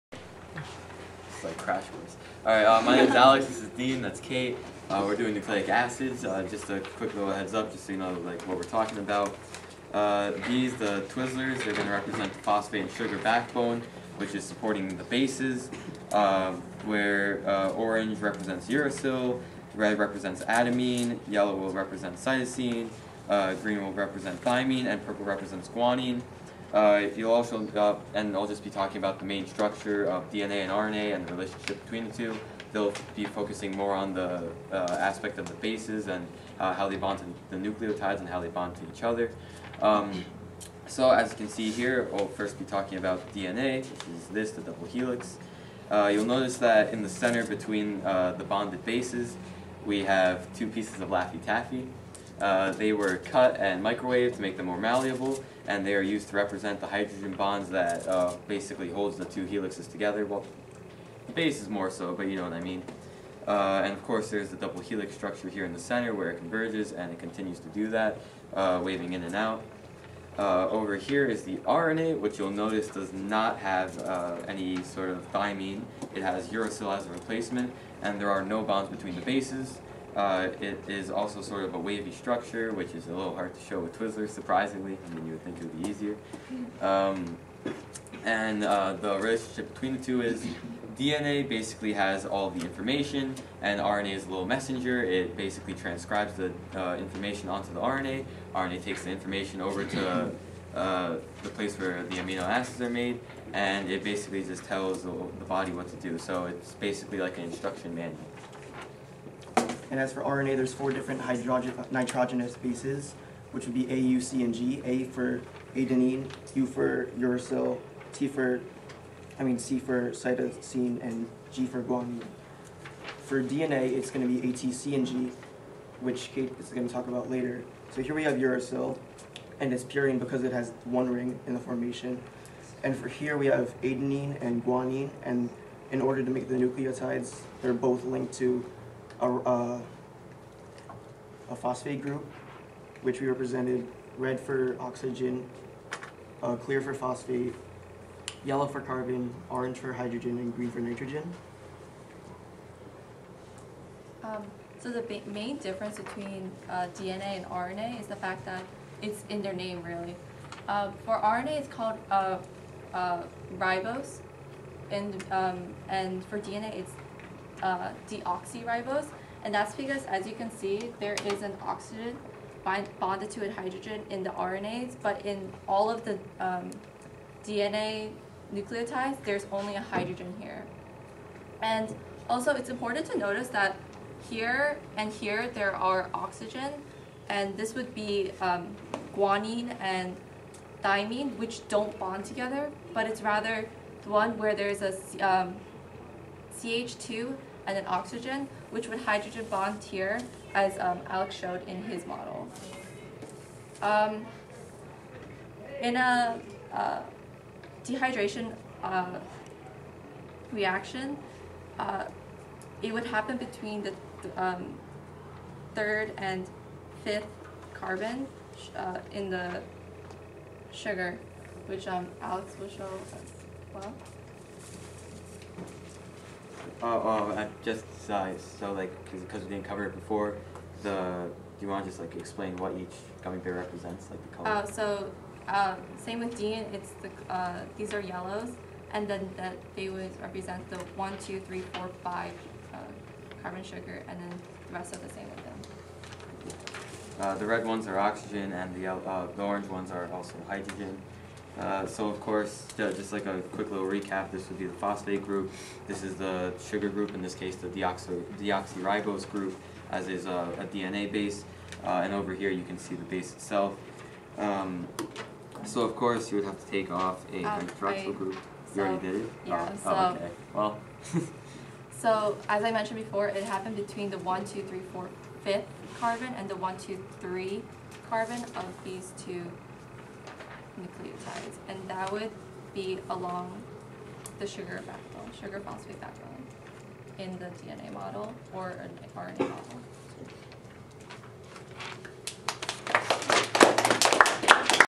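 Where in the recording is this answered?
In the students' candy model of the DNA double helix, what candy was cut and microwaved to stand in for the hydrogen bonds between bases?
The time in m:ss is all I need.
0:51.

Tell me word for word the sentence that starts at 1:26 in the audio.
Um, and uh, the relationship between the two is DNA basically has all the information, and RNA is a little messenger.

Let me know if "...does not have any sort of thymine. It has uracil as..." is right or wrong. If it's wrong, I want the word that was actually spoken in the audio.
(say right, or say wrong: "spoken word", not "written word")
right.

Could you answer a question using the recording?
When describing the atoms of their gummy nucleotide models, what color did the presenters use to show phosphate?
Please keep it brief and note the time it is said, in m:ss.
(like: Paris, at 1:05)
Clear, at 2:26.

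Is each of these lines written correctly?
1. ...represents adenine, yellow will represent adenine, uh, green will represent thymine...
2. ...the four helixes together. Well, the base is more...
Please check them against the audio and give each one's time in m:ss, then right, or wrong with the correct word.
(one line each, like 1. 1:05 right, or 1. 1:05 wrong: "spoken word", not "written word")
1. 0:19 wrong: "cytosine", not "adenine"
2. 0:59 wrong: "two", not "four".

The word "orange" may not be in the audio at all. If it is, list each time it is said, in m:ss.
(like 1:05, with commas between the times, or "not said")
0:17, 2:29, 4:09.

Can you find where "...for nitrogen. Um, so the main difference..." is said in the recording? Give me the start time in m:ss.
2:30.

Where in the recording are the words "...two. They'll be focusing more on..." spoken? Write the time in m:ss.
0:32.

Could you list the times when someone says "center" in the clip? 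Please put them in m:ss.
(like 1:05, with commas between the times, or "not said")
0:47, 1:05.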